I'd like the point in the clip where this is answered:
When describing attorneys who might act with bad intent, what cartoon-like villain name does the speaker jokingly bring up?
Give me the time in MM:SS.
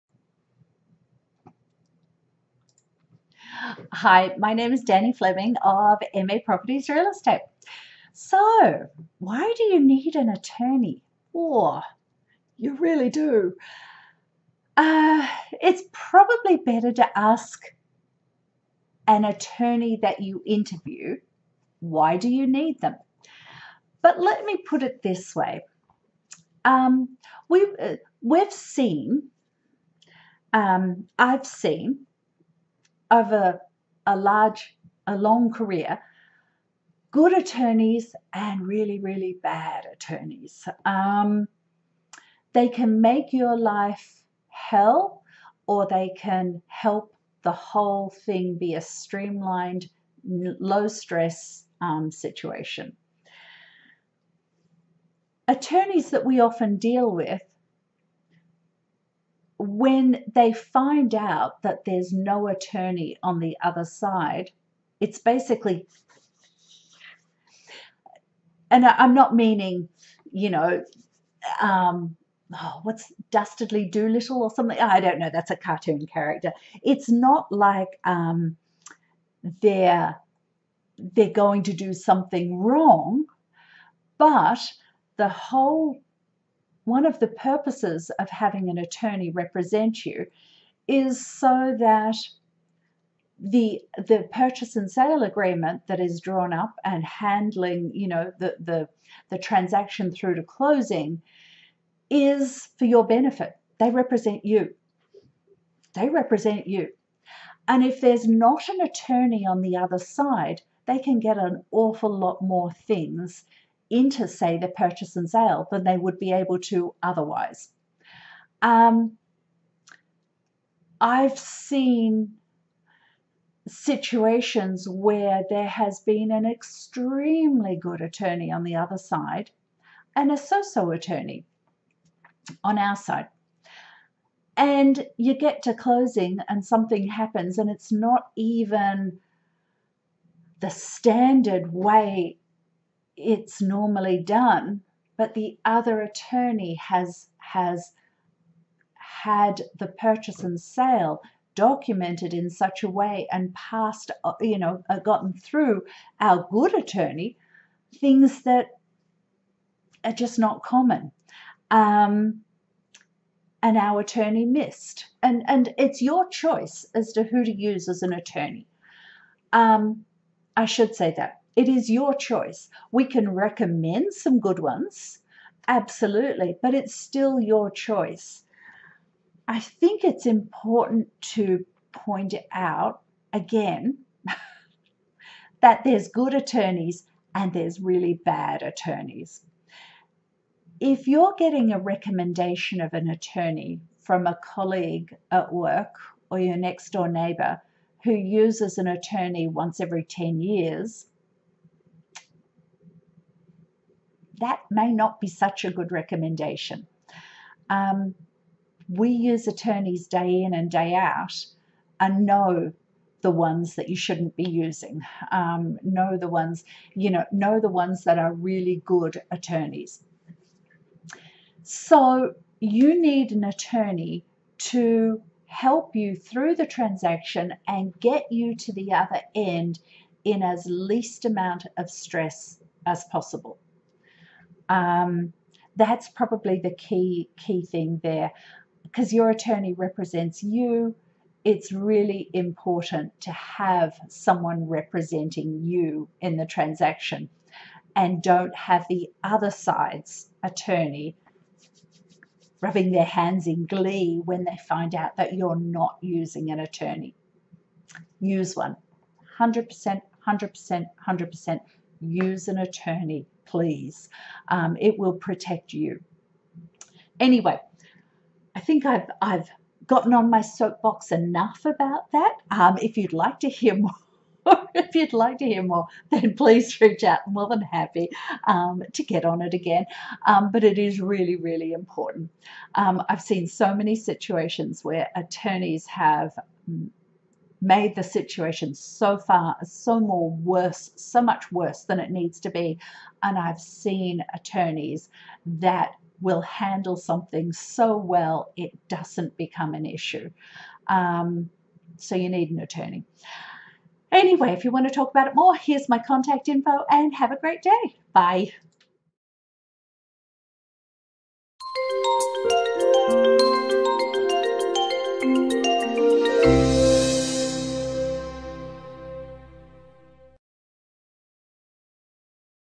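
01:13.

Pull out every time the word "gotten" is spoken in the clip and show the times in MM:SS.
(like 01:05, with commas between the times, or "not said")
02:34, 04:29.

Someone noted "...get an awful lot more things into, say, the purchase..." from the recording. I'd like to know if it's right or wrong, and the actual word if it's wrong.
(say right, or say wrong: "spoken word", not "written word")
right.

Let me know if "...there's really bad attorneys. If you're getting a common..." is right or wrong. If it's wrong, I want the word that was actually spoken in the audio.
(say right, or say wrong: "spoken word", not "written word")
wrong: "recommendation", not "common".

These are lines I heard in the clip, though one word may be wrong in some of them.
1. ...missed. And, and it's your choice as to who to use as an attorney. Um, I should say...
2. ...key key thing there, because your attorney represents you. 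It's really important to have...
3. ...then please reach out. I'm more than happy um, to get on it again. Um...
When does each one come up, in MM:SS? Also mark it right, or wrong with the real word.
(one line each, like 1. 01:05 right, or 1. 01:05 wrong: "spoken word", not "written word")
1. 02:44 right
2. 03:56 right
3. 04:36 right.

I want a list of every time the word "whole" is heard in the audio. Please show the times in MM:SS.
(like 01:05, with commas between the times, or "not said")
00:47, 01:25.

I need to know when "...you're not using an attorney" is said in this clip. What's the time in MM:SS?
04:15.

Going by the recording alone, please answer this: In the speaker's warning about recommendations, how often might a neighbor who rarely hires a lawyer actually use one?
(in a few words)
once every 10 years.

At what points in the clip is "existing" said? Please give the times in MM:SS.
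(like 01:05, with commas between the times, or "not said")
not said.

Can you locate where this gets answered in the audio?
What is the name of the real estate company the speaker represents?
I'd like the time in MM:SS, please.
00:06.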